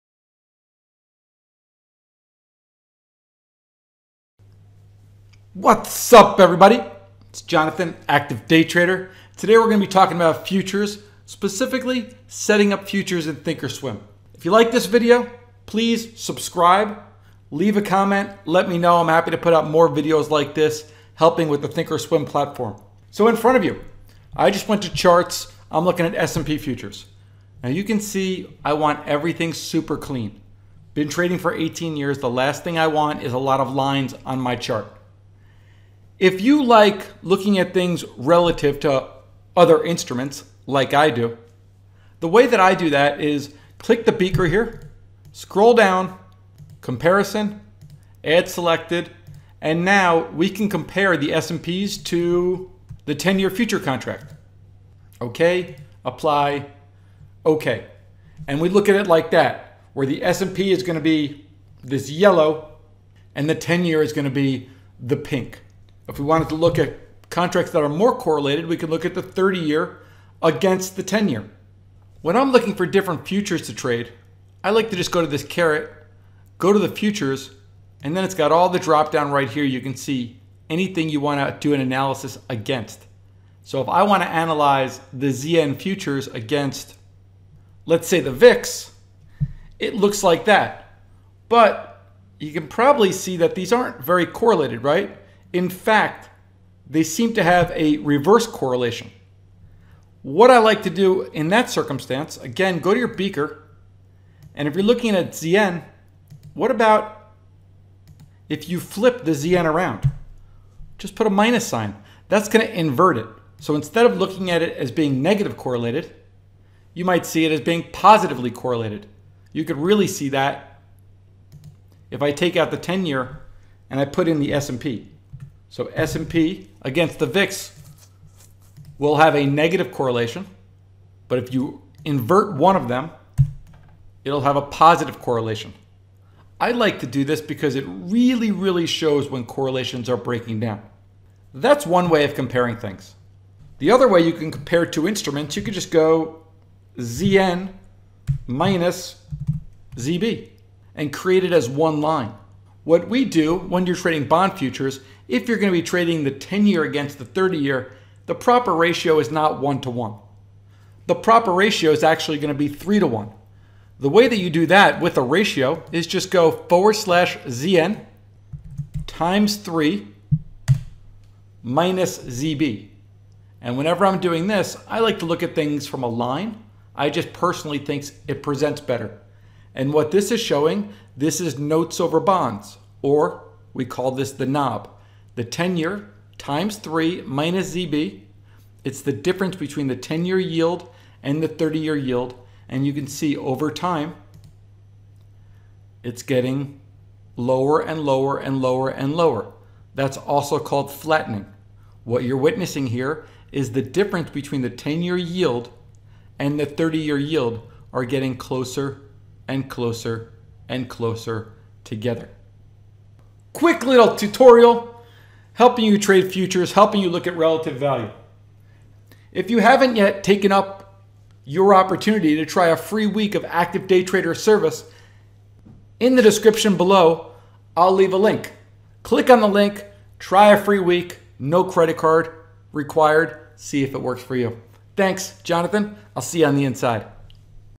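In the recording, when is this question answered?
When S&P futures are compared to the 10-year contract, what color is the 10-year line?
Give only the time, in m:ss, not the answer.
1:05.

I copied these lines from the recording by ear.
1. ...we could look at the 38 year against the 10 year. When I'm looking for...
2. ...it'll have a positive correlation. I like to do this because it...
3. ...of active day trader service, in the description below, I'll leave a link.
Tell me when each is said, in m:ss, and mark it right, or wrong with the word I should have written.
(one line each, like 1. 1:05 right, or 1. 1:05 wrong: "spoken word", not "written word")
1. 1:08 wrong: "30", not "38"
2. 2:14 right
3. 3:43 right.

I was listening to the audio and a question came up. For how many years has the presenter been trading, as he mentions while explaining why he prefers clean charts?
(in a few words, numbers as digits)
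18.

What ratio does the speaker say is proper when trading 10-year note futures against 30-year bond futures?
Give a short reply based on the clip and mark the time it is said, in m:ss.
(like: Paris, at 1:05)
3 to 1, at 2:42.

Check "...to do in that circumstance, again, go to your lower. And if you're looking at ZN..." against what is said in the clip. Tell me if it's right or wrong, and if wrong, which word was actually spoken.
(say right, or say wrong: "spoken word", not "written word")
wrong: "beaker", not "lower".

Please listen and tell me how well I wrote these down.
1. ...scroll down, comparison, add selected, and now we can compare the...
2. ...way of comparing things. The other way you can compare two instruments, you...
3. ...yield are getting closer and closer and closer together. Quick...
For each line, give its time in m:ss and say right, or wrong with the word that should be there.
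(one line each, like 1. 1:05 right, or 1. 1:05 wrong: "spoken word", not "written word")
1. 0:45 right
2. 2:22 right
3. 3:27 right.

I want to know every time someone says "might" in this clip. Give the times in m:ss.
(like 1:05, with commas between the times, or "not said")
1:57.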